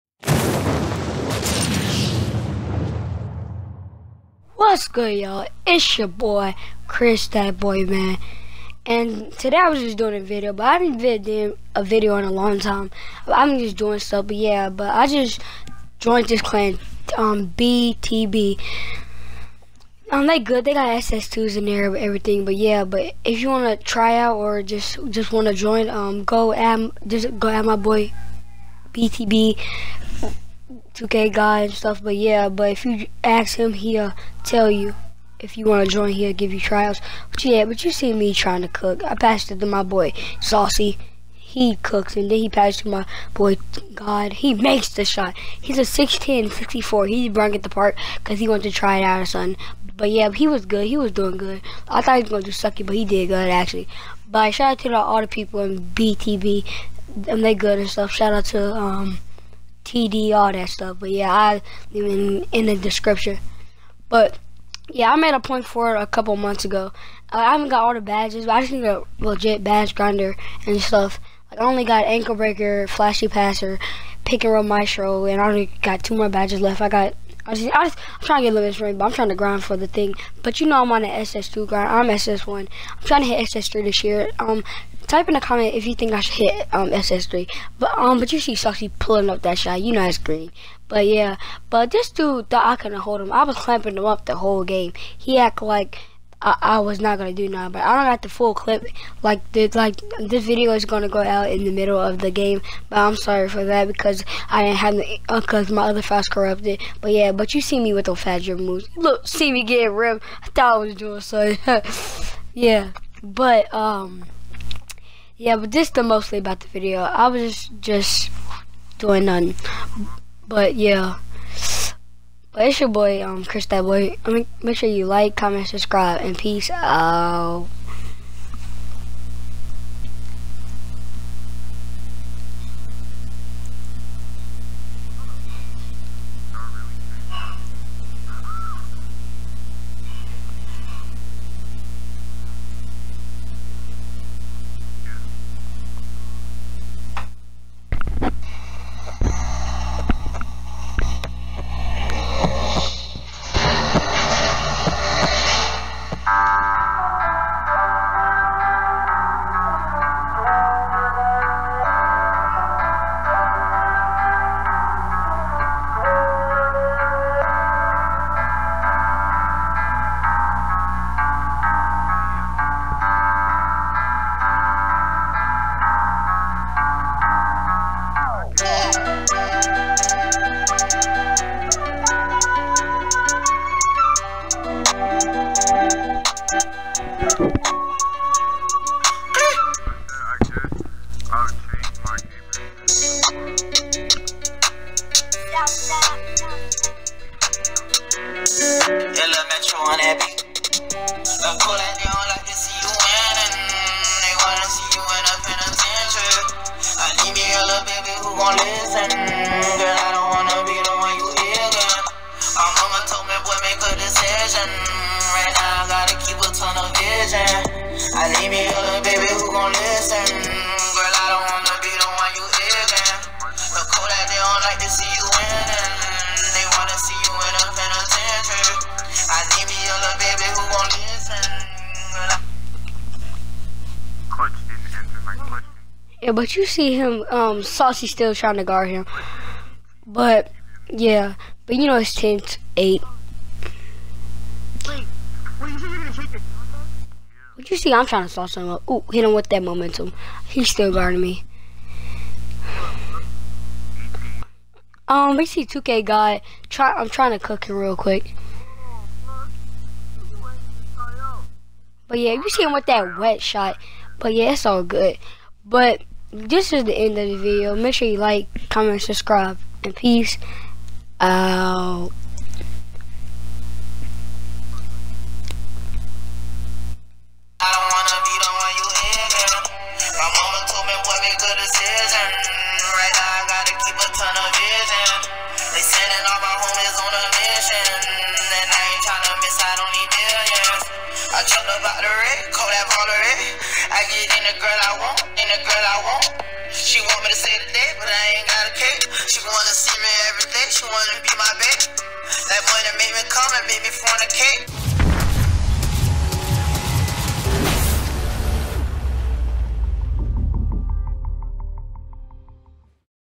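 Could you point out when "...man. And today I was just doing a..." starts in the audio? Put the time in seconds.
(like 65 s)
7 s.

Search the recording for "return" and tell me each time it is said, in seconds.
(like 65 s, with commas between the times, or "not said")
not said.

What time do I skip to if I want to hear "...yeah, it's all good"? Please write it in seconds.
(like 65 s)
264 s.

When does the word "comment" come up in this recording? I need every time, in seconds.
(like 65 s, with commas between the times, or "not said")
85 s, 125 s, 268 s.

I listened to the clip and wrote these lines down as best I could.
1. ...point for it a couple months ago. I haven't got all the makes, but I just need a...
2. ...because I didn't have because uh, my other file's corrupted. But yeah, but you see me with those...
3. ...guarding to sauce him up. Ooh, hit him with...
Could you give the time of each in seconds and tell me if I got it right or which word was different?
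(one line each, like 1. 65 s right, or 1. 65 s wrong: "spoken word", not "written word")
1. 65 s wrong: "badges", not "makes"
2. 103 s right
3. 248 s wrong: "trying", not "guarding".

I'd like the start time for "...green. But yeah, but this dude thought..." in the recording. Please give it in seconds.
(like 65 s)
90 s.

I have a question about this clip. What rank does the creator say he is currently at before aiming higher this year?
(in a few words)
SS1.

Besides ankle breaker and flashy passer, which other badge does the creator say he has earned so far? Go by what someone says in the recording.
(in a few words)
Pick and roll maestro.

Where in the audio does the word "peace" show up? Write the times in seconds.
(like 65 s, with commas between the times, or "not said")
126 s, 269 s.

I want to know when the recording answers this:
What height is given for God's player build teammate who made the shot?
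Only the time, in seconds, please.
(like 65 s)
45 s.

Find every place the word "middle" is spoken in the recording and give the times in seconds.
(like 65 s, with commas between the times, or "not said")
101 s.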